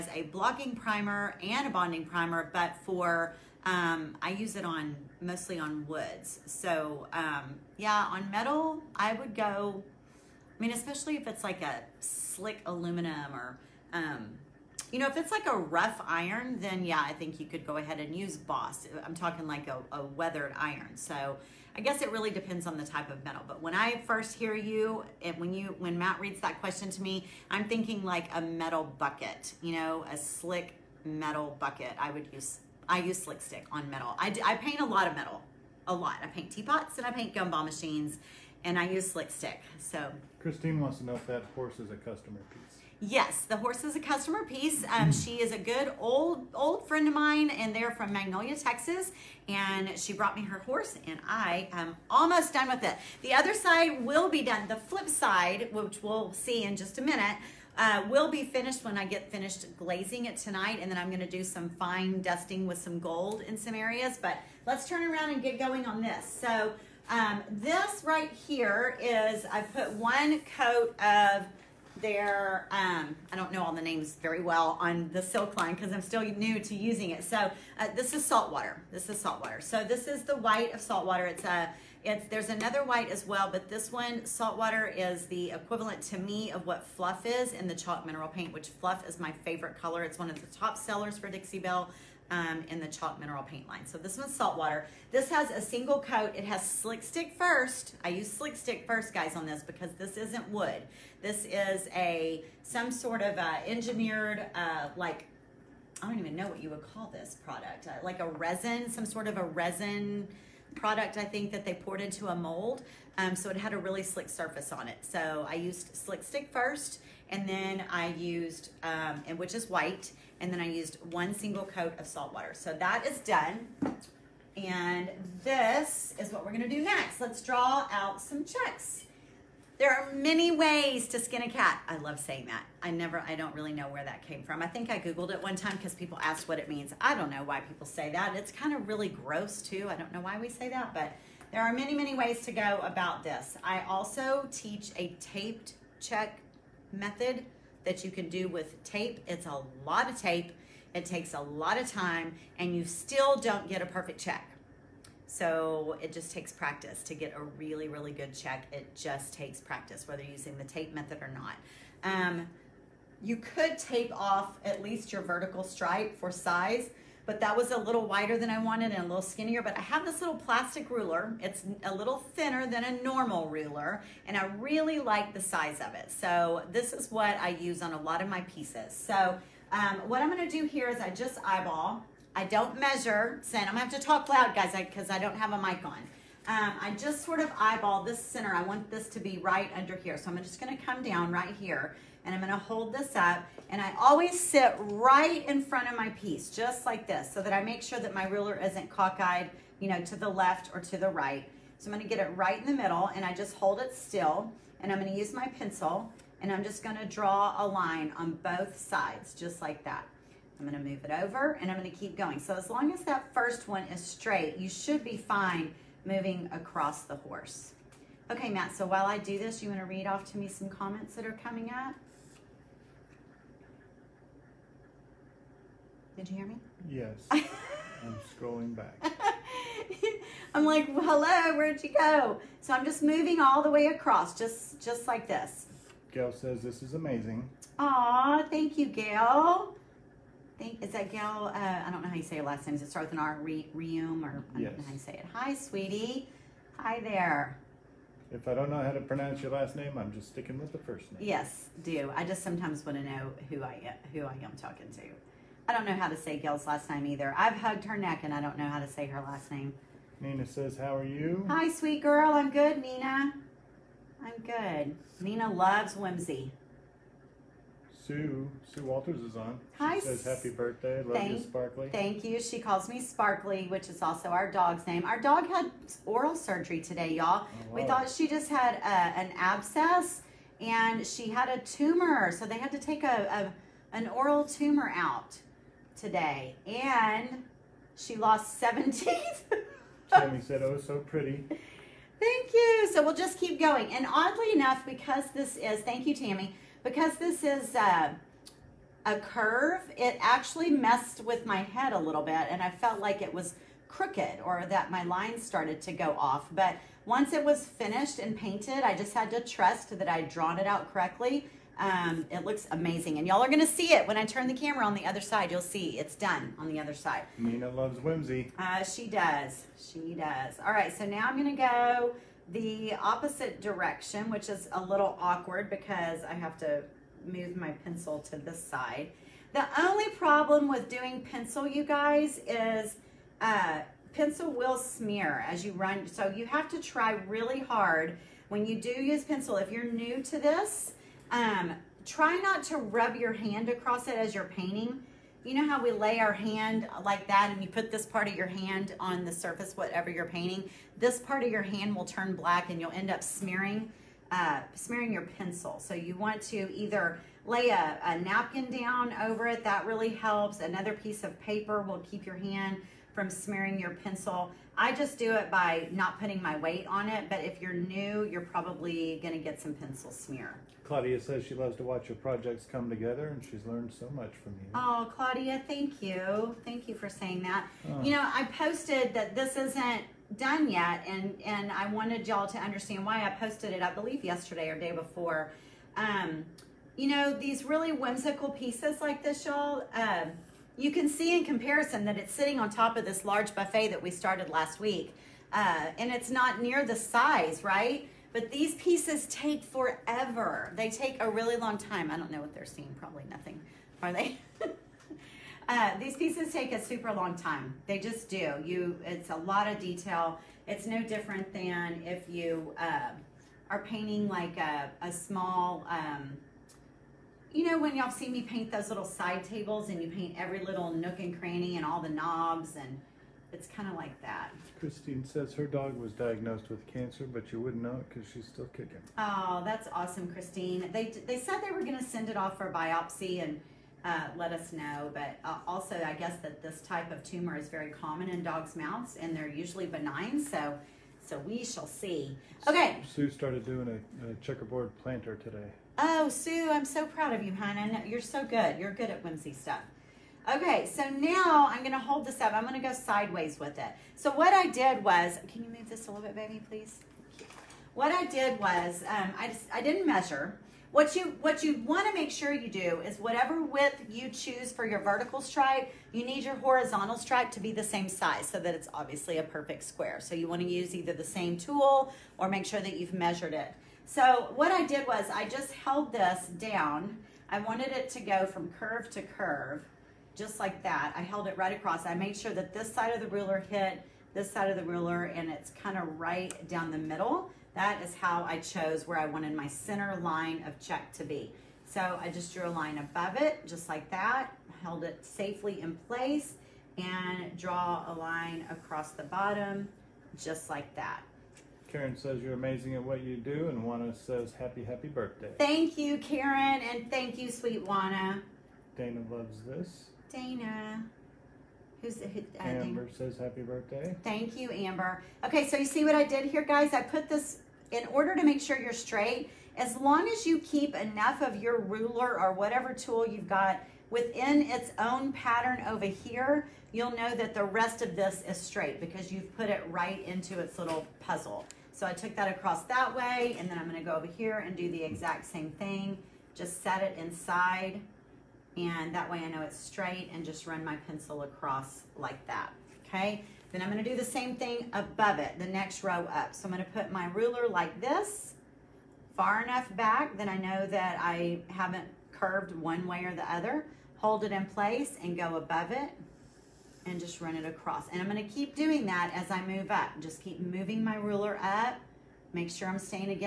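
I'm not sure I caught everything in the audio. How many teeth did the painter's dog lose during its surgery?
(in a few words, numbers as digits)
7.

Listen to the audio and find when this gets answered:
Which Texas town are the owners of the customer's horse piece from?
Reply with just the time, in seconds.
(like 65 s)
48 s.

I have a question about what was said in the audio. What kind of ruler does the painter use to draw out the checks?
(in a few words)
little plastic ruler.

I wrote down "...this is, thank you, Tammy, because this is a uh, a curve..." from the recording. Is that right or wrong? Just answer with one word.
right.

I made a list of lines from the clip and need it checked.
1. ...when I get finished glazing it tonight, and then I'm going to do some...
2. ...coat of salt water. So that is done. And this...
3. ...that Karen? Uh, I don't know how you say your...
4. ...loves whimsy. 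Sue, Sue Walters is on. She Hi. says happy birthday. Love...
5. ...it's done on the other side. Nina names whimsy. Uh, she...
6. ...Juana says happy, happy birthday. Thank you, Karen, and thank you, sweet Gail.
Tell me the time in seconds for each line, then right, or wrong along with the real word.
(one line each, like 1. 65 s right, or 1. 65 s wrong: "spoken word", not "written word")
1. 58 s right
2. 121 s right
3. 240 s wrong: "Gail", not "Karen"
4. 265 s right
5. 315 s wrong: "loves", not "names"
6. 503 s wrong: "Juana", not "Gail".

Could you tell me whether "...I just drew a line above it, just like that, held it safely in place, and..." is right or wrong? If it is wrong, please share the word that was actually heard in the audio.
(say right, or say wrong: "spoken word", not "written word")
right.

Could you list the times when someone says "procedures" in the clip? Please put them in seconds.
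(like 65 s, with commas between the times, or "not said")
not said.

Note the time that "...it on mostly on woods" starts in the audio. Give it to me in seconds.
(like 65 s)
4 s.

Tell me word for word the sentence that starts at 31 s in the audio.
I would use I use slick stick on metal.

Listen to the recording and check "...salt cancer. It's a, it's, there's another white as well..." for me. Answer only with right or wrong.
wrong.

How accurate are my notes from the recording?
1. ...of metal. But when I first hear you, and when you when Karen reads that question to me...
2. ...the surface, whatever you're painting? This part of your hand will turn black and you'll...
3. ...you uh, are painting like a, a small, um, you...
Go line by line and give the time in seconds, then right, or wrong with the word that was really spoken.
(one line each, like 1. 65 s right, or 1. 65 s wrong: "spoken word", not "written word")
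1. 23 s wrong: "Matt", not "Karen"
2. 349 s right
3. 412 s right.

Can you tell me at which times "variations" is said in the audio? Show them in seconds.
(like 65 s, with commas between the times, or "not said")
not said.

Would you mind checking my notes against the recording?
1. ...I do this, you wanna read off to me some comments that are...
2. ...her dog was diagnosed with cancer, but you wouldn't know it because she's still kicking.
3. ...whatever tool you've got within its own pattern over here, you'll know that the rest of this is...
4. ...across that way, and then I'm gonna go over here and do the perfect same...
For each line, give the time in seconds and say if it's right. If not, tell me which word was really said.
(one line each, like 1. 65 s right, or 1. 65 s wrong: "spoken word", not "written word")
1. 219 s right
2. 425 s right
3. 522 s right
4. 532 s wrong: "exact", not "perfect".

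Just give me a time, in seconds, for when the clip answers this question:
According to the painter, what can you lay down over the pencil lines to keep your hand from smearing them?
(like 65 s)
358 s.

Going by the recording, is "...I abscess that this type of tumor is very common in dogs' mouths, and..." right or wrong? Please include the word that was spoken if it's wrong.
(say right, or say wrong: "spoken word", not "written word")
wrong: "guess", not "abscess".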